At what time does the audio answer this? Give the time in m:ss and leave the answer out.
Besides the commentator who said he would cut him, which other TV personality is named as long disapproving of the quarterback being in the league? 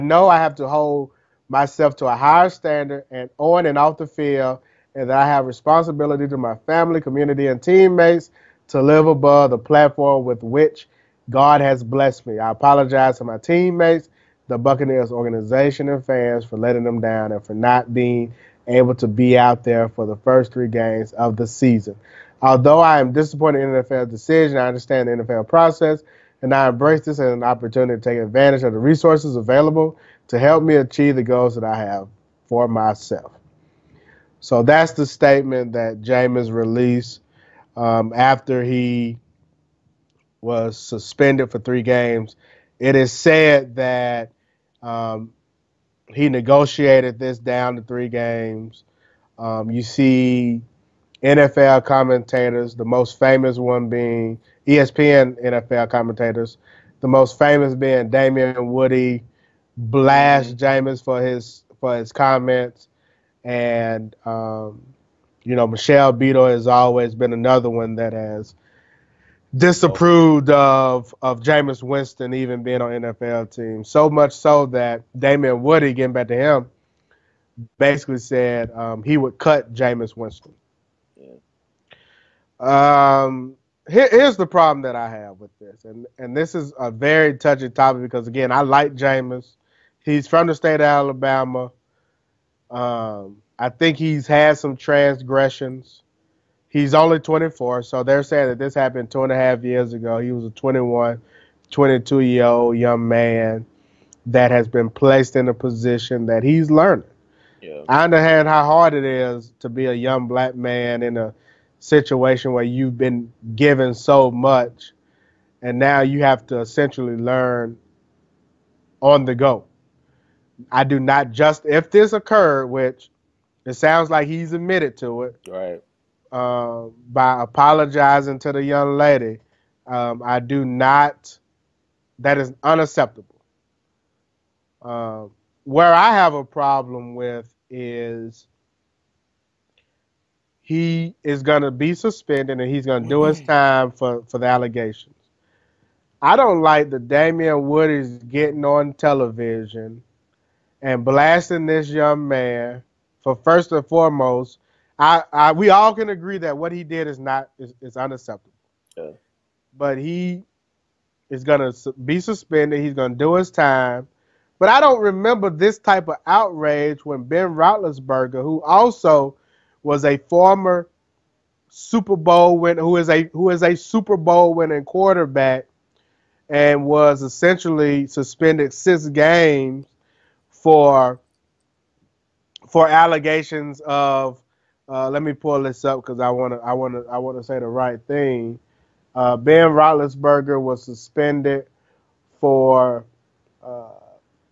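1:05.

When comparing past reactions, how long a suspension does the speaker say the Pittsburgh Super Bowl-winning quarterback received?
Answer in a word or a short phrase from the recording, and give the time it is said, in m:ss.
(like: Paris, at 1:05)
6 games, at 2:58.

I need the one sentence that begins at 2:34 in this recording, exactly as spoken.
I, I we all can agree that what he did is not is, is unacceptable.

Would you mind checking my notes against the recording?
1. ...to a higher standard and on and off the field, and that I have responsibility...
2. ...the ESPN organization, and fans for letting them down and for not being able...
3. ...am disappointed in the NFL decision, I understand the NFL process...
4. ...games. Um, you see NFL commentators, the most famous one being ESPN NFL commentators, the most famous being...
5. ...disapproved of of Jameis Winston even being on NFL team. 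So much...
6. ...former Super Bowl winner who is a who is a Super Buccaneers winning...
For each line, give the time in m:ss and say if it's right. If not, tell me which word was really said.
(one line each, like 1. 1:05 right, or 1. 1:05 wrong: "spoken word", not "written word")
1. 0:01 right
2. 0:14 wrong: "Buccaneers", not "ESPN"
3. 0:22 right
4. 0:48 right
5. 1:09 right
6. 2:50 wrong: "Bowl", not "Buccaneers".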